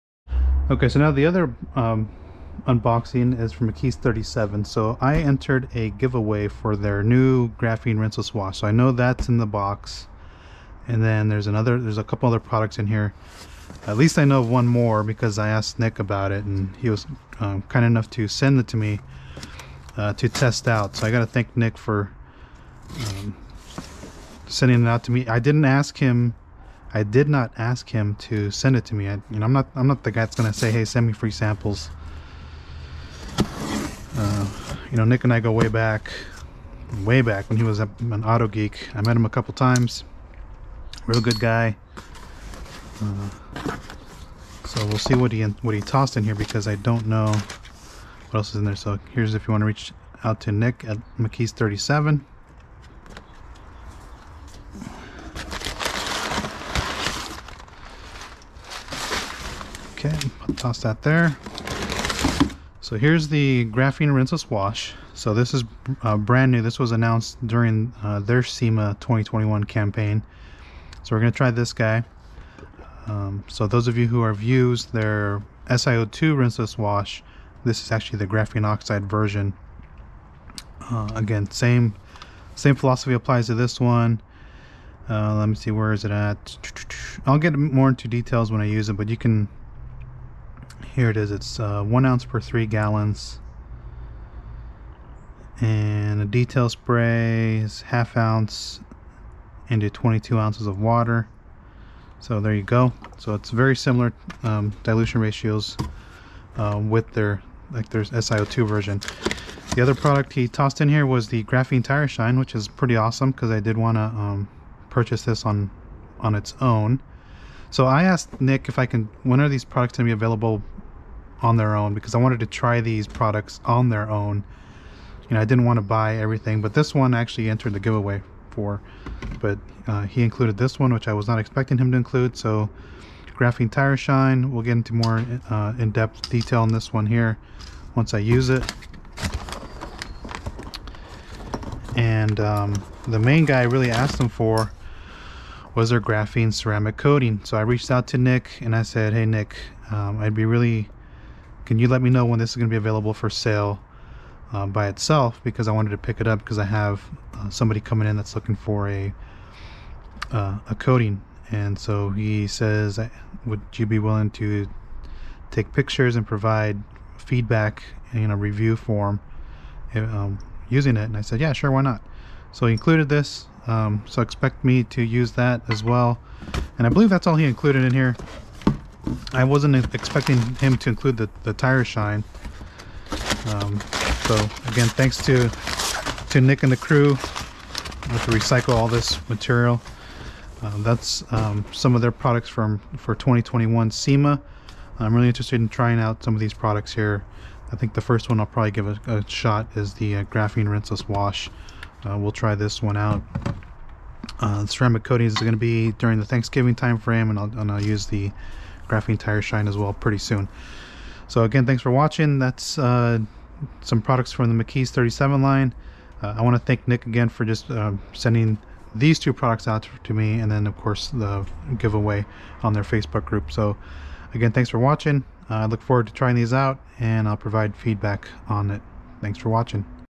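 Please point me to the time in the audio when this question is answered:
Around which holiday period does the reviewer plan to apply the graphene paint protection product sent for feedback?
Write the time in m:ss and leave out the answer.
3:26.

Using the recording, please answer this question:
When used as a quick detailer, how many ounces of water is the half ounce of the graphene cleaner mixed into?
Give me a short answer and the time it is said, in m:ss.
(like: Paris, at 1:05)
22, at 1:39.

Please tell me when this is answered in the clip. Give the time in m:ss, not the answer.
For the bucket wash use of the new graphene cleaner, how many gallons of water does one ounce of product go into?
1:32.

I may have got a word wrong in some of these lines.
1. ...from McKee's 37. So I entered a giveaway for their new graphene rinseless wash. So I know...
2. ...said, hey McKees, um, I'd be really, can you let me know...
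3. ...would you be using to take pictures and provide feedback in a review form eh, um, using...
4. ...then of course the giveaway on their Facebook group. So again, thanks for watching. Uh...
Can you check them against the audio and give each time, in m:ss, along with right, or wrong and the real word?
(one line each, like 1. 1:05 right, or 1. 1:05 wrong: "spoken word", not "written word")
1. 0:03 right
2. 2:28 wrong: "Nick", not "McKees"
3. 2:43 wrong: "willing", not "using"
4. 3:40 right.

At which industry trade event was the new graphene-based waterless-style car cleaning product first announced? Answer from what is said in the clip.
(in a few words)
SEMA 2021.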